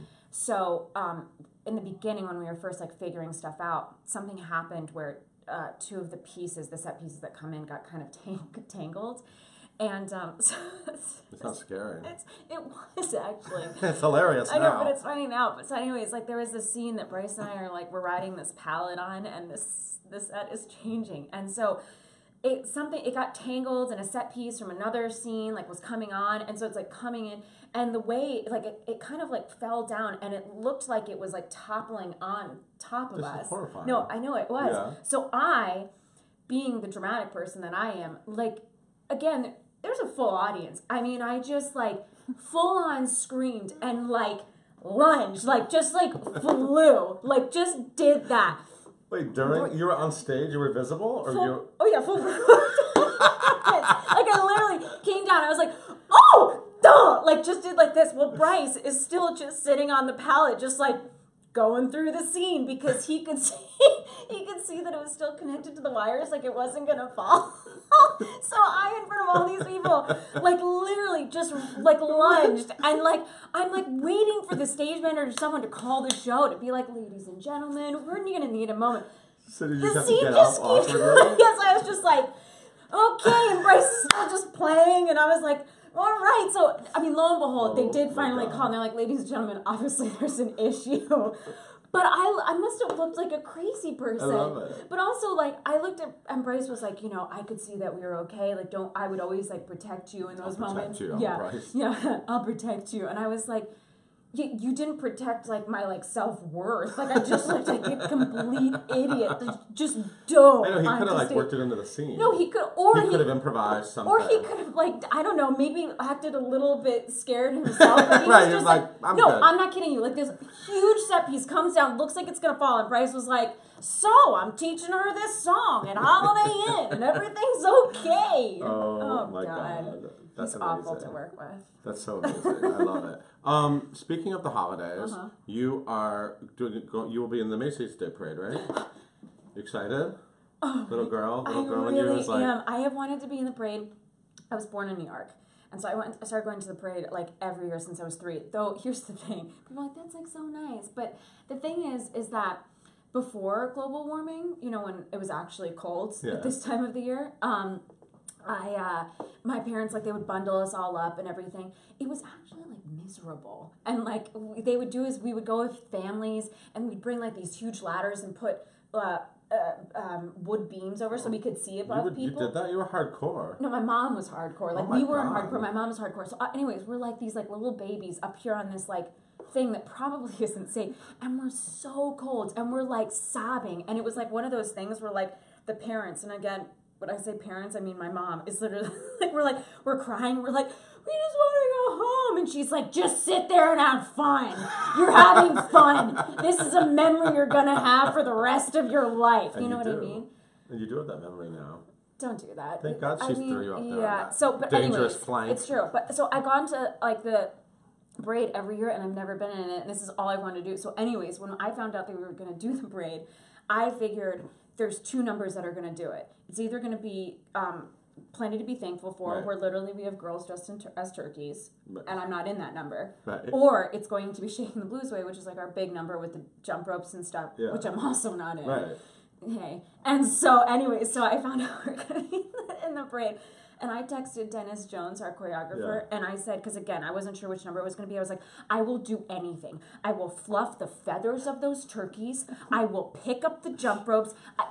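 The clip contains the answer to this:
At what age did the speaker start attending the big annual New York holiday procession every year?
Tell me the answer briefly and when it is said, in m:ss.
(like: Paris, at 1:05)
3, at 2:28.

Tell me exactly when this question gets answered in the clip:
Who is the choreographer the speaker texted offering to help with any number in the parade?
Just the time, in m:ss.
3:54.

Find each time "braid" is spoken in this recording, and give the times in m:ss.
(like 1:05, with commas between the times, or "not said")
3:28, 3:32, 3:53.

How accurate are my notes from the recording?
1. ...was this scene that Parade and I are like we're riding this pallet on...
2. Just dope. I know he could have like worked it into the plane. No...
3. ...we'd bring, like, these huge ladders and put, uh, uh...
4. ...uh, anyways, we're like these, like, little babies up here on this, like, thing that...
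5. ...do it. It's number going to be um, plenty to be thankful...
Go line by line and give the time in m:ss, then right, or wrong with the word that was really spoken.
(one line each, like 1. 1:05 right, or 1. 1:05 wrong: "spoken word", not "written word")
1. 0:16 wrong: "Bryce", not "Parade"
2. 1:49 wrong: "scene", not "plane"
3. 2:46 right
4. 2:56 right
5. 3:36 wrong: "either", not "number".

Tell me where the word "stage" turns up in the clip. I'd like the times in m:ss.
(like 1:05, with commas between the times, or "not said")
0:50, 1:14.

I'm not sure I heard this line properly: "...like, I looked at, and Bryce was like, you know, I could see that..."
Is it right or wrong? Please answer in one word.
right.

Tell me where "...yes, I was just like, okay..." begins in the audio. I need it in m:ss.
1:20.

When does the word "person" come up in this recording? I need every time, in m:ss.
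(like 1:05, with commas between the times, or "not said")
0:37, 1:33.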